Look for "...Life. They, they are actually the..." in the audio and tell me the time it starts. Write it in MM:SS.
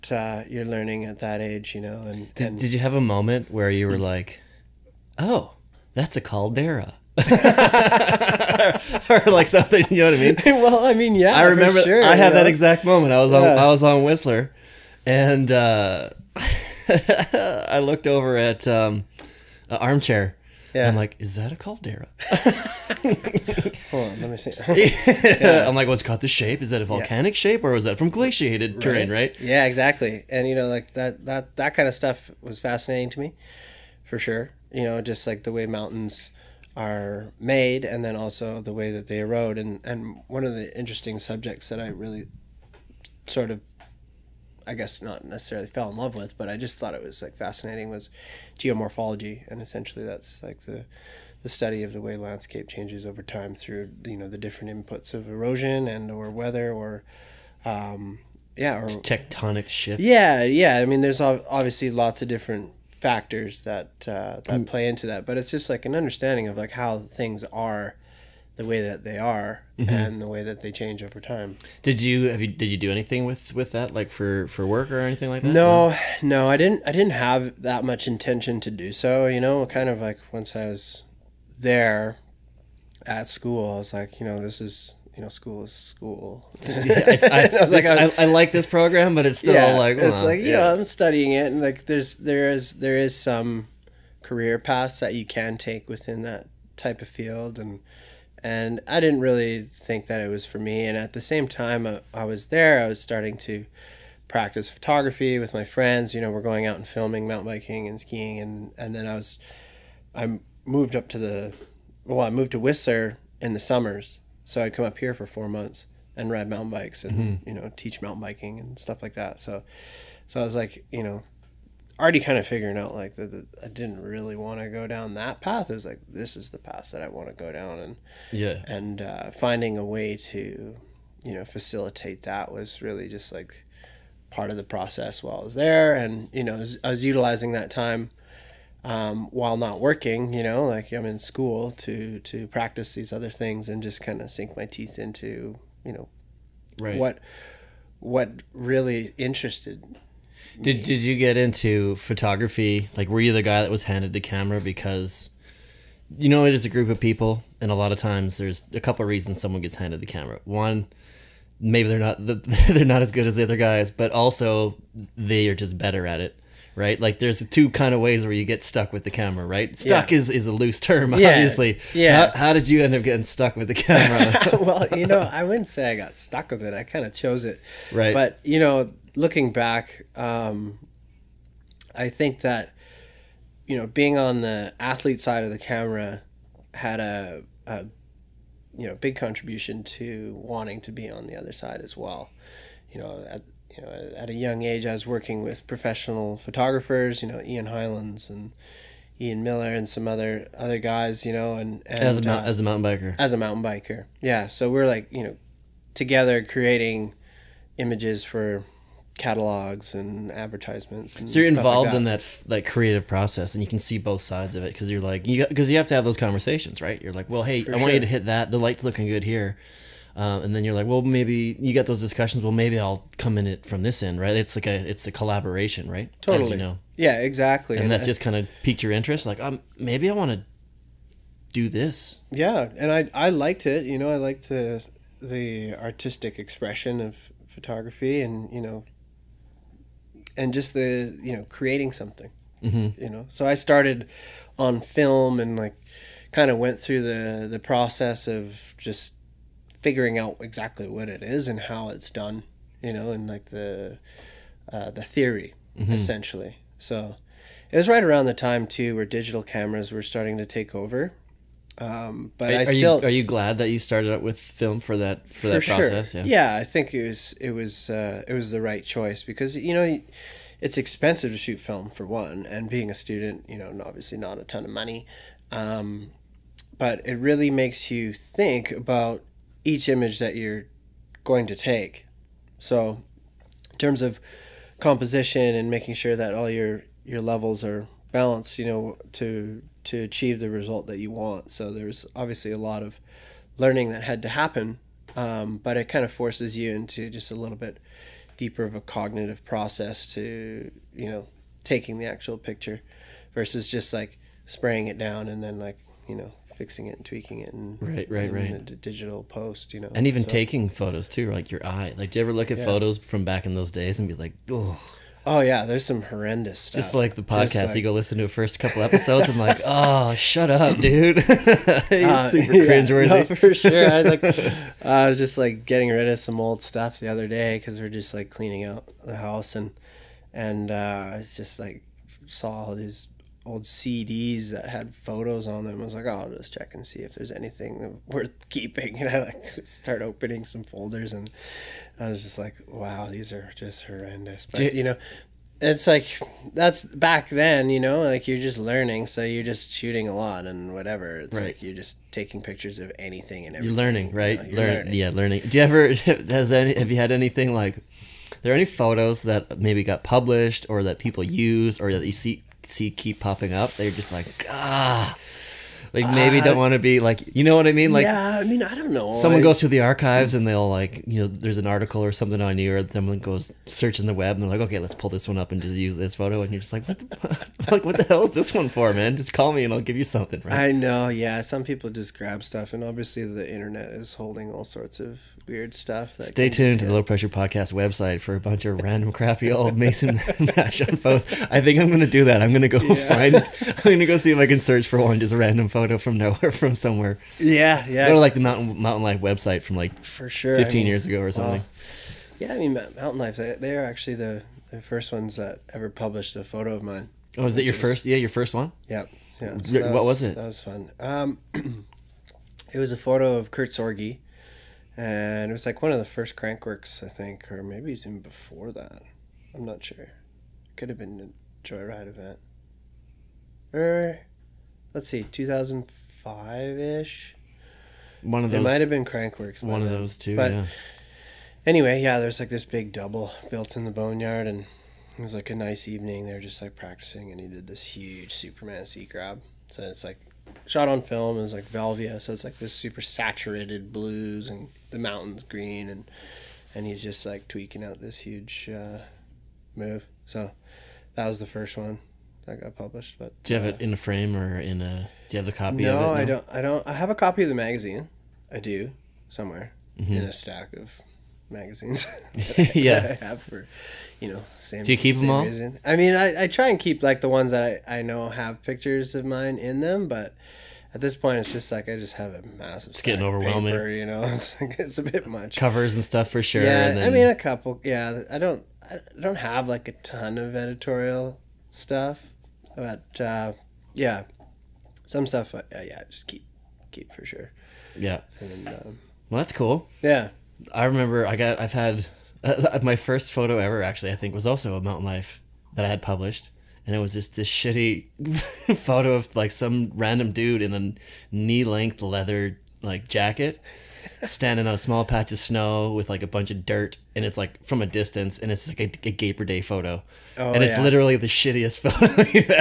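06:43.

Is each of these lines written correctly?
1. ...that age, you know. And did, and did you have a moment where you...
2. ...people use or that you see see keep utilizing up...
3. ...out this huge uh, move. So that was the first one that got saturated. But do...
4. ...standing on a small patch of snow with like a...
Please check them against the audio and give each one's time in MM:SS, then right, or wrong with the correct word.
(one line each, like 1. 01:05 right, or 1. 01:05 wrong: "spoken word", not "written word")
1. 00:01 right
2. 06:00 wrong: "popping", not "utilizing"
3. 07:27 wrong: "published", not "saturated"
4. 08:24 right.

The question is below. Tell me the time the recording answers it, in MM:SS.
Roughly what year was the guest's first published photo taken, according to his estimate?
07:05.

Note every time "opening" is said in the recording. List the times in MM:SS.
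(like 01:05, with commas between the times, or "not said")
05:40.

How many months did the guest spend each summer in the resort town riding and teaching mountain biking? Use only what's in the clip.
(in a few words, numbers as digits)
4.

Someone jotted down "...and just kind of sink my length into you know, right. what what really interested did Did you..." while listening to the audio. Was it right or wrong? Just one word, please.
wrong.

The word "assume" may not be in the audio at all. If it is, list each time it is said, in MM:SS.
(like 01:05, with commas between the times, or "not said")
not said.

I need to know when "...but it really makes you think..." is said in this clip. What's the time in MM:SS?
04:36.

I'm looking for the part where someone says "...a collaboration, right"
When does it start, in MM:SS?
03:45.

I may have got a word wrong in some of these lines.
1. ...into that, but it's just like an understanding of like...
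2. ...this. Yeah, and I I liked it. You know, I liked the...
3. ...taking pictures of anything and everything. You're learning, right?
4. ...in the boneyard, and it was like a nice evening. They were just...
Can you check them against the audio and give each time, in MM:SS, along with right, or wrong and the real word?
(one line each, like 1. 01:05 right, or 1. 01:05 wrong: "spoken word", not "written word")
1. 01:04 right
2. 03:51 right
3. 05:52 right
4. 07:13 right.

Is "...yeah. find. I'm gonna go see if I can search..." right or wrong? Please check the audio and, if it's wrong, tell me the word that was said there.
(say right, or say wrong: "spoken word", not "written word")
right.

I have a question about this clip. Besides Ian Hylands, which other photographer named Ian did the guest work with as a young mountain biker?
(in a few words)
Ian Miller.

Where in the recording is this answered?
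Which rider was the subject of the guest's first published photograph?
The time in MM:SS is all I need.
06:53.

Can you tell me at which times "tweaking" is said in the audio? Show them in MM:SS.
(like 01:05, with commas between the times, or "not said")
05:07, 07:27.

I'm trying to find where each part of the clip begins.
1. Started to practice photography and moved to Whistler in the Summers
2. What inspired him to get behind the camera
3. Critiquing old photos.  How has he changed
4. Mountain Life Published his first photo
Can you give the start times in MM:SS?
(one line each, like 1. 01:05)
1. 01:50
2. 02:55
3. 05:10
4. 06:40.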